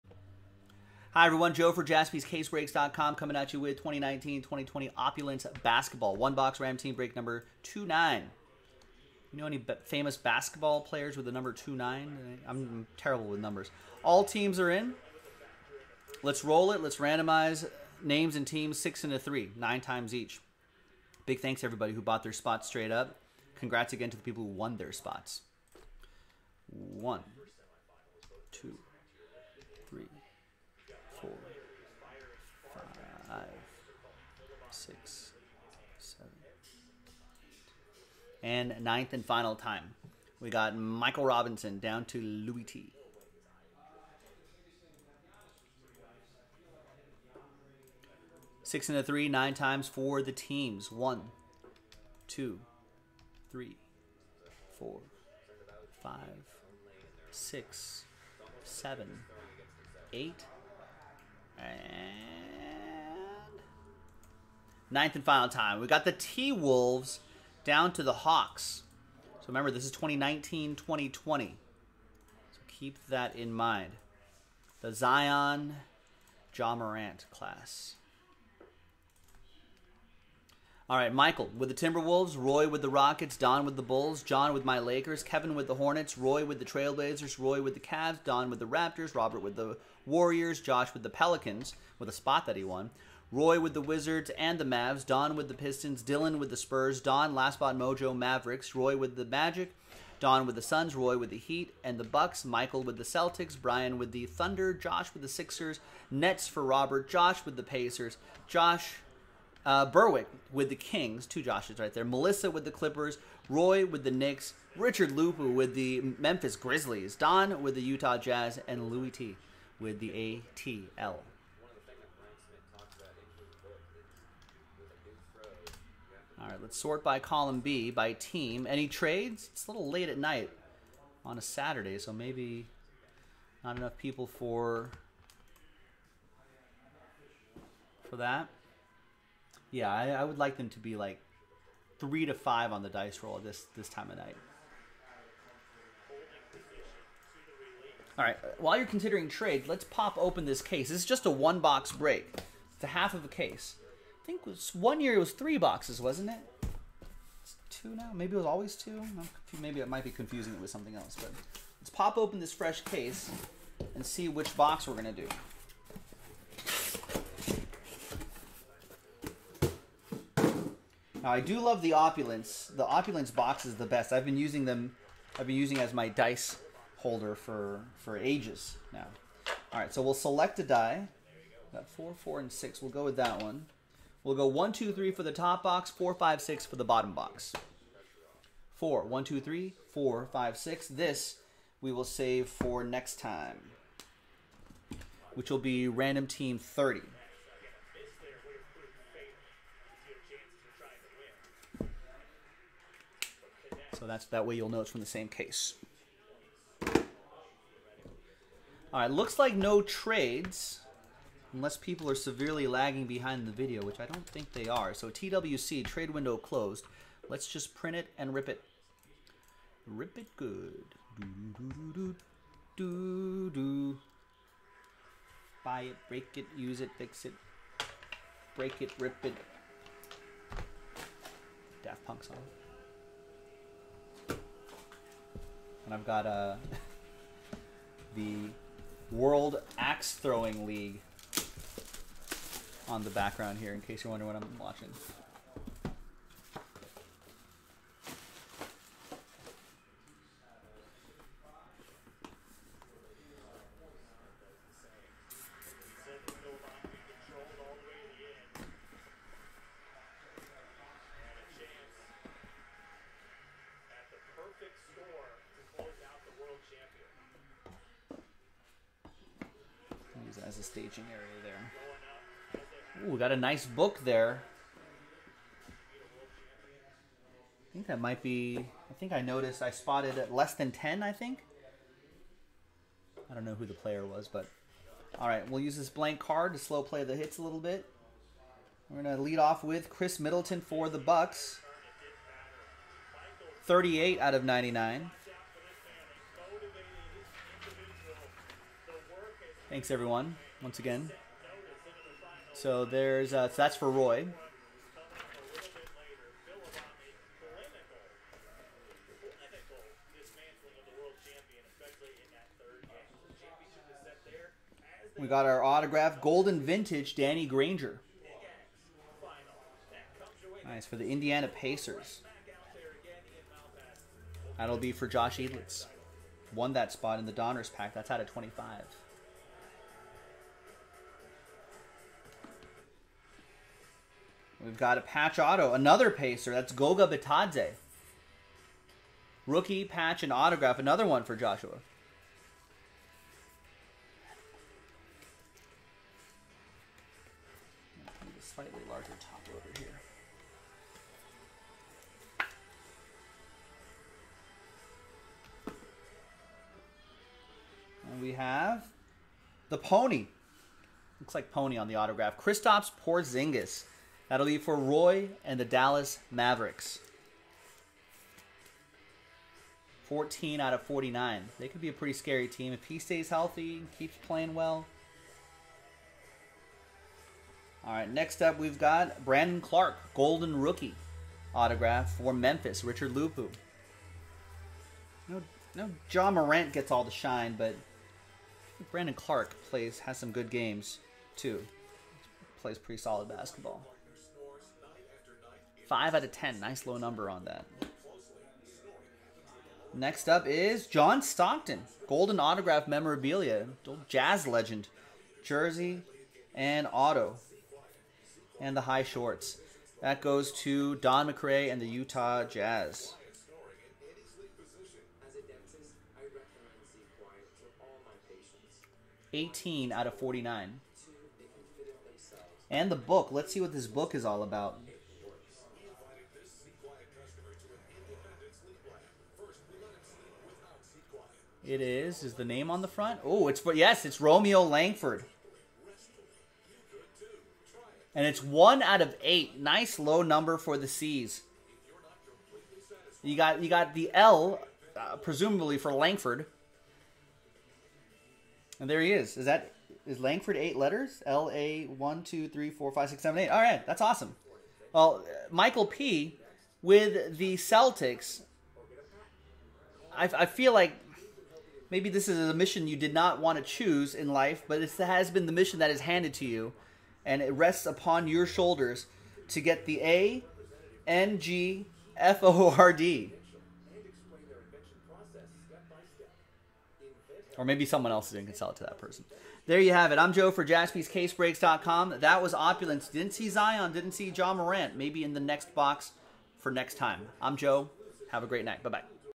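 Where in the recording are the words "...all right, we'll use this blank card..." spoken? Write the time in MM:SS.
04:45.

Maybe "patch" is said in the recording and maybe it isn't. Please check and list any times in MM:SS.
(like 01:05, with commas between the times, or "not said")
05:35, 05:39.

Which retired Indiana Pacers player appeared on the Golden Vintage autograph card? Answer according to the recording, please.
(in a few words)
Danny Granger.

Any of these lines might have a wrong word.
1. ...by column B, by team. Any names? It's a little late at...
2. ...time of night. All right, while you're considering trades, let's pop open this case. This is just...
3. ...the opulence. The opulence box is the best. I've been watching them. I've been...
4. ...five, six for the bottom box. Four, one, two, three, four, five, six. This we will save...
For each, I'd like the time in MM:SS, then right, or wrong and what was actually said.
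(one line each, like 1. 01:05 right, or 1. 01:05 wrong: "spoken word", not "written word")
1. 02:07 wrong: "trades", not "names"
2. 02:23 right
3. 02:51 wrong: "using", not "watching"
4. 03:06 right.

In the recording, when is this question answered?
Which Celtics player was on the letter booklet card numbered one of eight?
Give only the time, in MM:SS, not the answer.
07:14.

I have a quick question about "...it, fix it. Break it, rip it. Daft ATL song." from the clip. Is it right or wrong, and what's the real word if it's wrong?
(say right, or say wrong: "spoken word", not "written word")
wrong: "Punk", not "ATL".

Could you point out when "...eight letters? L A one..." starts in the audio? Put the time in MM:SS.
07:30.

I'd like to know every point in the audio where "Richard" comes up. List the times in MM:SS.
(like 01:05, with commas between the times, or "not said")
01:54, 06:22.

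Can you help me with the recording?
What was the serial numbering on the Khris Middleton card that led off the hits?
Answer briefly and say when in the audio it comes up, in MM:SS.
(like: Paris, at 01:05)
38/99, at 04:53.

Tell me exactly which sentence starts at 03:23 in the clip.
So that's that way you'll know it's from the same case.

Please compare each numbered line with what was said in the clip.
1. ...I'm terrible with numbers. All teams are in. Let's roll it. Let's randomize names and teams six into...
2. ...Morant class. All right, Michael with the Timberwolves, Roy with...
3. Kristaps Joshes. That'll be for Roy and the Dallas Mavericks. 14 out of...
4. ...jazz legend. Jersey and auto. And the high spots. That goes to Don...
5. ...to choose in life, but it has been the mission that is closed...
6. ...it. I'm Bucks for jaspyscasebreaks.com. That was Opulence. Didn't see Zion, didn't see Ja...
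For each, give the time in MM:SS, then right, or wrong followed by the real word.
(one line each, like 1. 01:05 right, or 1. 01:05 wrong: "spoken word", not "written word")
1. 00:11 right
2. 01:16 right
3. 06:02 wrong: "Porzingis", not "Joshes"
4. 06:44 wrong: "shorts", not "spots"
5. 07:43 wrong: "handed", not "closed"
6. 08:00 wrong: "Joe", not "Bucks".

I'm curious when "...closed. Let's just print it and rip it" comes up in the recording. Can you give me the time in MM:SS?
03:36.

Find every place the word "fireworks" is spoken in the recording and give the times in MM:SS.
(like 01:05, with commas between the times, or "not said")
not said.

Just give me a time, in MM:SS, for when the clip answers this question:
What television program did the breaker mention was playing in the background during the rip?
03:59.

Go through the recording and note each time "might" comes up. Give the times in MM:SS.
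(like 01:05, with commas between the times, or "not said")
02:39, 04:37.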